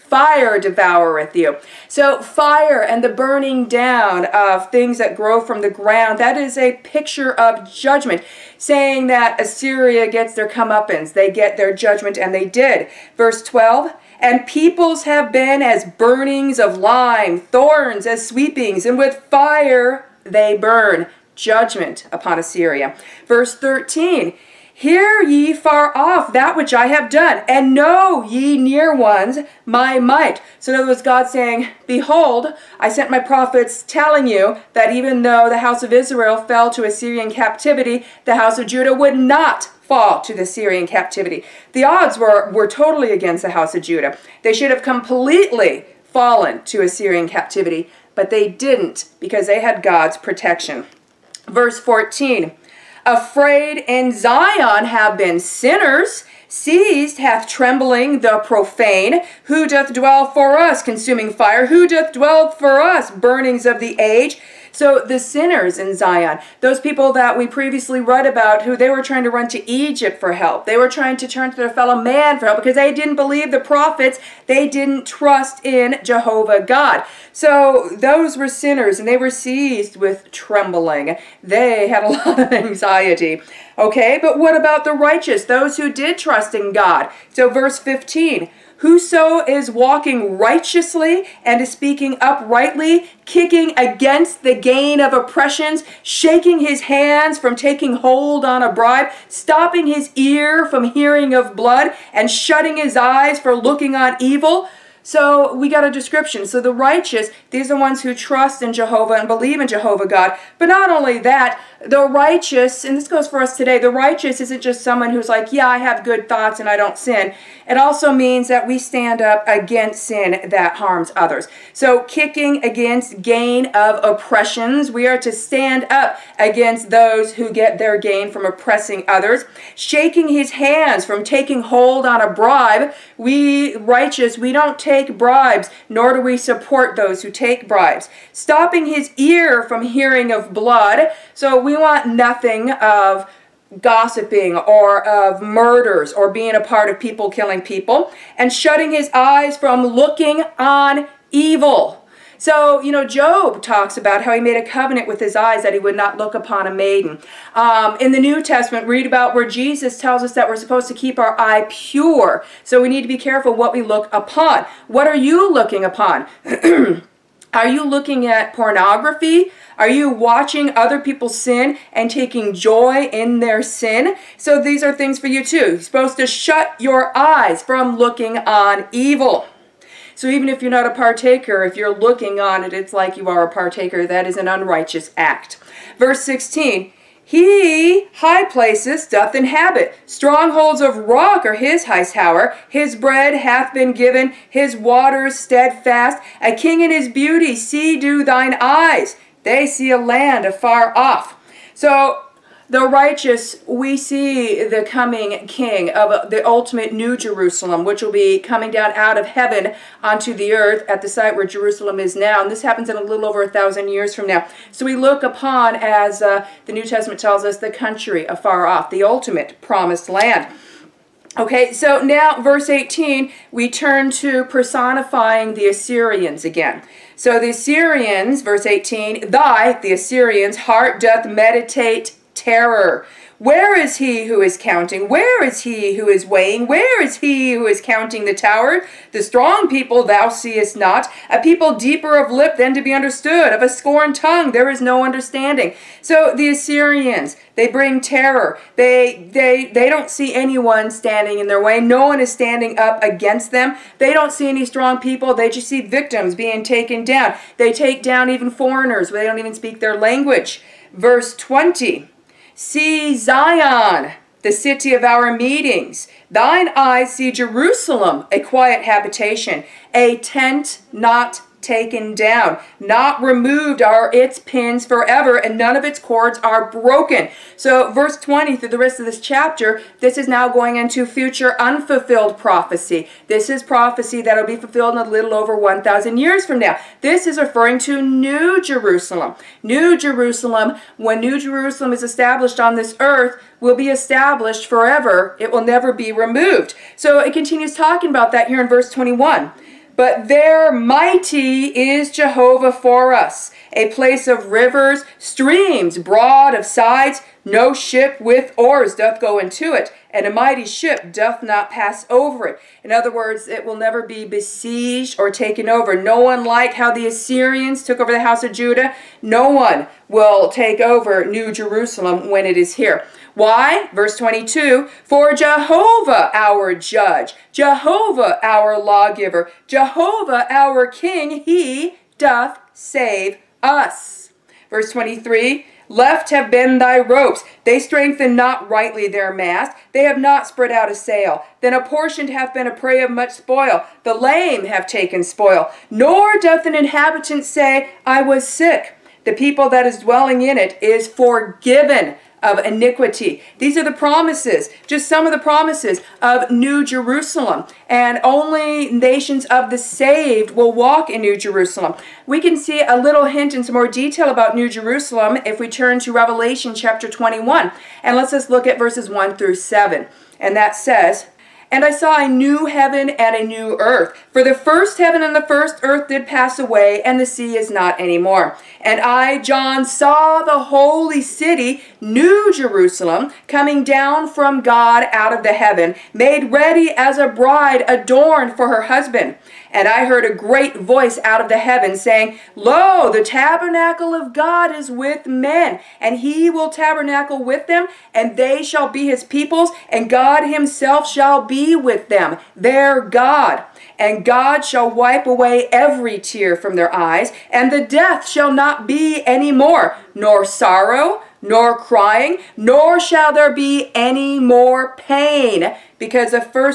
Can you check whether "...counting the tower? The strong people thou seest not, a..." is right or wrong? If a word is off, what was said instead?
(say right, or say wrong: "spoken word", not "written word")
right.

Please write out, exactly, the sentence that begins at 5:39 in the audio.
They have not spread out a sail.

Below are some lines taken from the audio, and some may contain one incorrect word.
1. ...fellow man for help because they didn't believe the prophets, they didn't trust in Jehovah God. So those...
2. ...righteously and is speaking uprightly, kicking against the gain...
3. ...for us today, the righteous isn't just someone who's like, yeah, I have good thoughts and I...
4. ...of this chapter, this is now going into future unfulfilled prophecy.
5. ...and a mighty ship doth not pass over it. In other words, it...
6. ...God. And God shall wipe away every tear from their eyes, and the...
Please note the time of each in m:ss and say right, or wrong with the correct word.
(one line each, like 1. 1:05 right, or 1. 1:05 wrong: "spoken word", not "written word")
1. 1:11 right
2. 1:30 right
3. 1:53 right
4. 4:38 right
5. 5:10 right
6. 6:43 right.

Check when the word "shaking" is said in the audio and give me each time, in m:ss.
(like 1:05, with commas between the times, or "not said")
1:36, 2:09.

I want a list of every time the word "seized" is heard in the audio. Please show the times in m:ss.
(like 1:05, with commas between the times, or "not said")
0:56, 1:19.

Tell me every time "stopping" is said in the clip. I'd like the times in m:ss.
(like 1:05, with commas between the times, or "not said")
1:39, 2:18.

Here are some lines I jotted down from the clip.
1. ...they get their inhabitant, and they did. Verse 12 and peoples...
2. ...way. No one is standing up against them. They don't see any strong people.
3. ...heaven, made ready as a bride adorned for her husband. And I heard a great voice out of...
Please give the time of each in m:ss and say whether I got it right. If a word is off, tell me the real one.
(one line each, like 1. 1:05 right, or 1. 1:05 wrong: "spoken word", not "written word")
1. 0:11 wrong: "judgment", not "inhabitant"
2. 4:11 right
3. 6:25 right.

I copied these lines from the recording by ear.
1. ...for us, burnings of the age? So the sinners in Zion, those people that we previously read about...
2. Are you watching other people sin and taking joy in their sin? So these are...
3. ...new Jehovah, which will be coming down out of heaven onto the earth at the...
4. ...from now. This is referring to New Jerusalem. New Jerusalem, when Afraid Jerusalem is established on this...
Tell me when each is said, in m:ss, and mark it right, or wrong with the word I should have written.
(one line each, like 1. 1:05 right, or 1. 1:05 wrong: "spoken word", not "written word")
1. 1:02 right
2. 2:49 right
3. 3:26 wrong: "Jerusalem", not "Jehovah"
4. 4:46 wrong: "New", not "Afraid".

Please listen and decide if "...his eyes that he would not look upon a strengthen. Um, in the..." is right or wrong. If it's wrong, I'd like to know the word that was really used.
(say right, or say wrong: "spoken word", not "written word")
wrong: "maiden", not "strengthen".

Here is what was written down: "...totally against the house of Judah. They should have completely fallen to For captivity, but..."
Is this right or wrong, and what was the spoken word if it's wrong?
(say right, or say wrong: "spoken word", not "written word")
wrong: "Assyrian", not "For".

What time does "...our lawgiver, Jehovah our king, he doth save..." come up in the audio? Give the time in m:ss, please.
5:28.